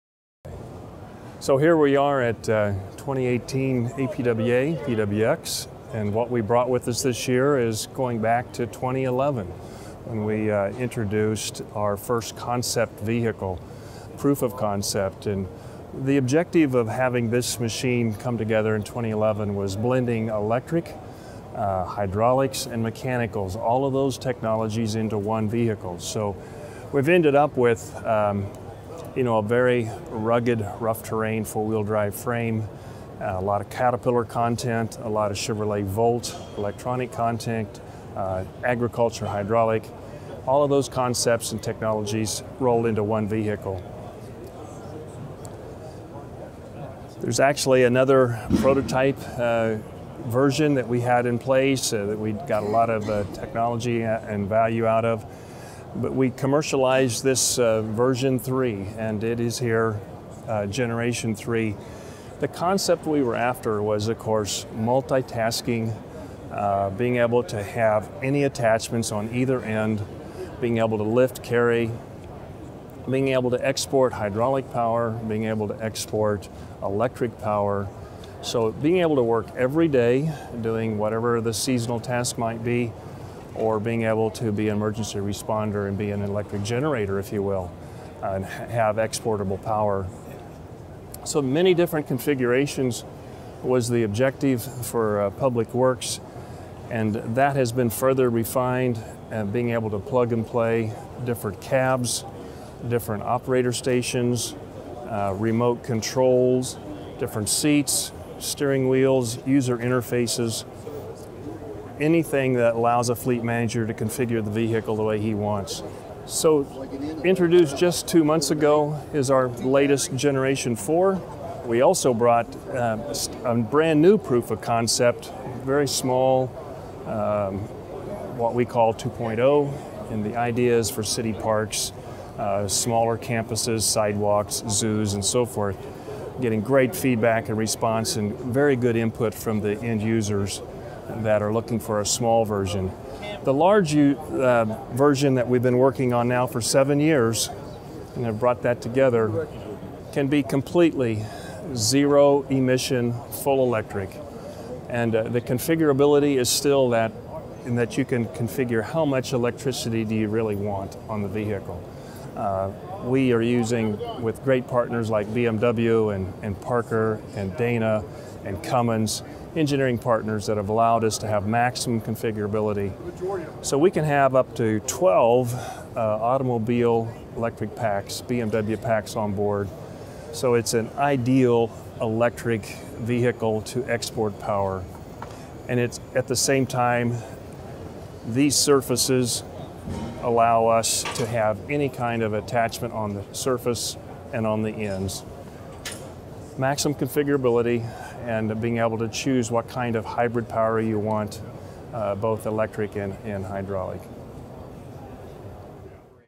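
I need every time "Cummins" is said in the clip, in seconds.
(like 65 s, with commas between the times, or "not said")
168 s.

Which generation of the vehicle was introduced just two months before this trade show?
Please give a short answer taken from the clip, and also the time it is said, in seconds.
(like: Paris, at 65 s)
Generation 4, at 120 s.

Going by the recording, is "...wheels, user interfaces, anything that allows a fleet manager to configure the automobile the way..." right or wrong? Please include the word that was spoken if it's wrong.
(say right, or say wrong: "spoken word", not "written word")
wrong: "vehicle", not "automobile".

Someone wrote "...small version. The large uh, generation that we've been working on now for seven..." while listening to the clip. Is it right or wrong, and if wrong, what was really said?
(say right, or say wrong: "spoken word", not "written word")
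wrong: "version", not "generation".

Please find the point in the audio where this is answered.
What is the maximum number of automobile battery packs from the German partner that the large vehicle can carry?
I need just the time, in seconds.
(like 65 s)
174 s.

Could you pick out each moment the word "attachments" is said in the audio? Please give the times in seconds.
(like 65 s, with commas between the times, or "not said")
68 s, 192 s.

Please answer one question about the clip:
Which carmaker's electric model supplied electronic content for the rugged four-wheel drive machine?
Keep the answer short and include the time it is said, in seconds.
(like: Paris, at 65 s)
Chevrolet Volt, at 35 s.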